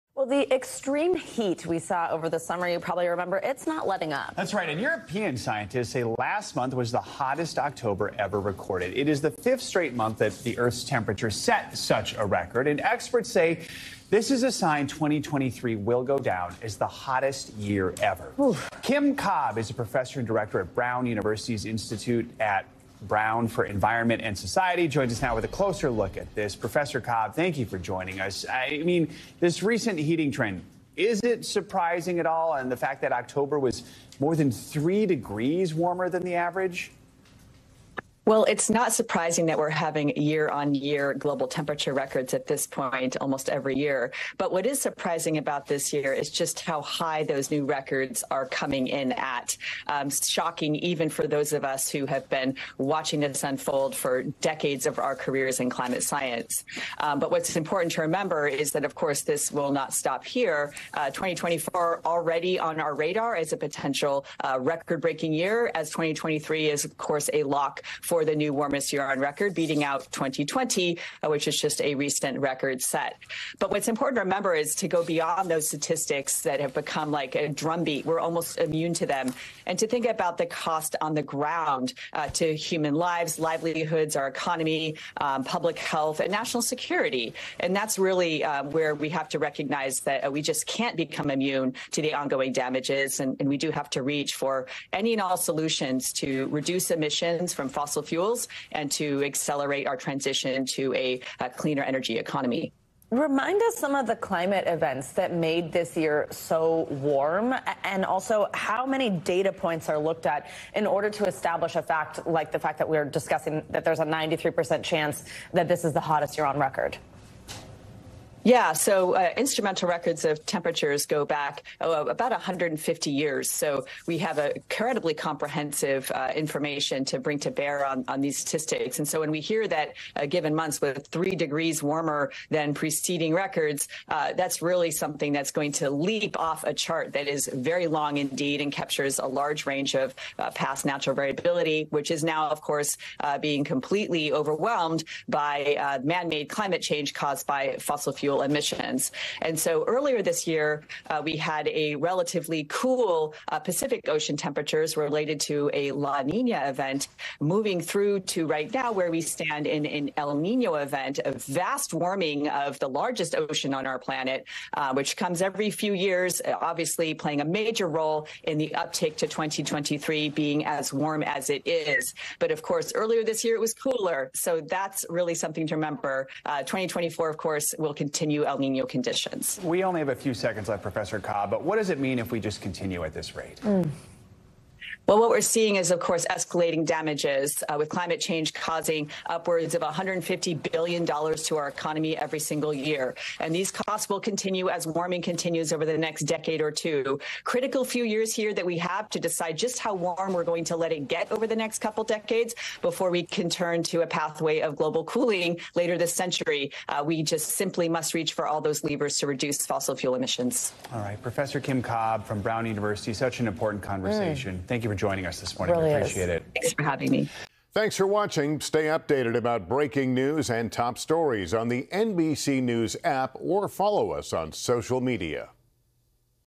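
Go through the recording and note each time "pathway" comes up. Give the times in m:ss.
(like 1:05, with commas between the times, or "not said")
3:24.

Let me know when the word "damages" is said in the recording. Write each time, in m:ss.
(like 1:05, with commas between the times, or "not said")
1:32, 3:06.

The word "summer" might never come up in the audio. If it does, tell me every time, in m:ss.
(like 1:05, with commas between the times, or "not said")
0:02.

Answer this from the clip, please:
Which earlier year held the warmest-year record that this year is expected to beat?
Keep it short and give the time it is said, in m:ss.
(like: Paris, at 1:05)
2020, at 1:10.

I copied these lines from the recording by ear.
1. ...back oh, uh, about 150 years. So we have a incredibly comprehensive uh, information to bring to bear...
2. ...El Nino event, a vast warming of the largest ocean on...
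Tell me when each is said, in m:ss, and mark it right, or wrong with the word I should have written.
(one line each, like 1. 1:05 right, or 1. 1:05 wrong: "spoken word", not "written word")
1. 2:01 right
2. 2:40 right.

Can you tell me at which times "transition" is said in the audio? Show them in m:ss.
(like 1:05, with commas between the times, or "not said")
1:39.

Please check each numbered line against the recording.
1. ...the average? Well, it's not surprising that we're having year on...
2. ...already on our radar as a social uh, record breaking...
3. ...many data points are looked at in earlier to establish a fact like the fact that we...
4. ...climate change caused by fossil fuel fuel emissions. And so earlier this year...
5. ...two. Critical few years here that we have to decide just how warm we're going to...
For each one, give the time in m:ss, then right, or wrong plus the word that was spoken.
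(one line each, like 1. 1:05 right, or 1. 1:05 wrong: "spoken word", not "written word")
1. 0:36 right
2. 1:02 wrong: "potential", not "social"
3. 1:48 wrong: "order", not "earlier"
4. 2:26 right
5. 3:16 right.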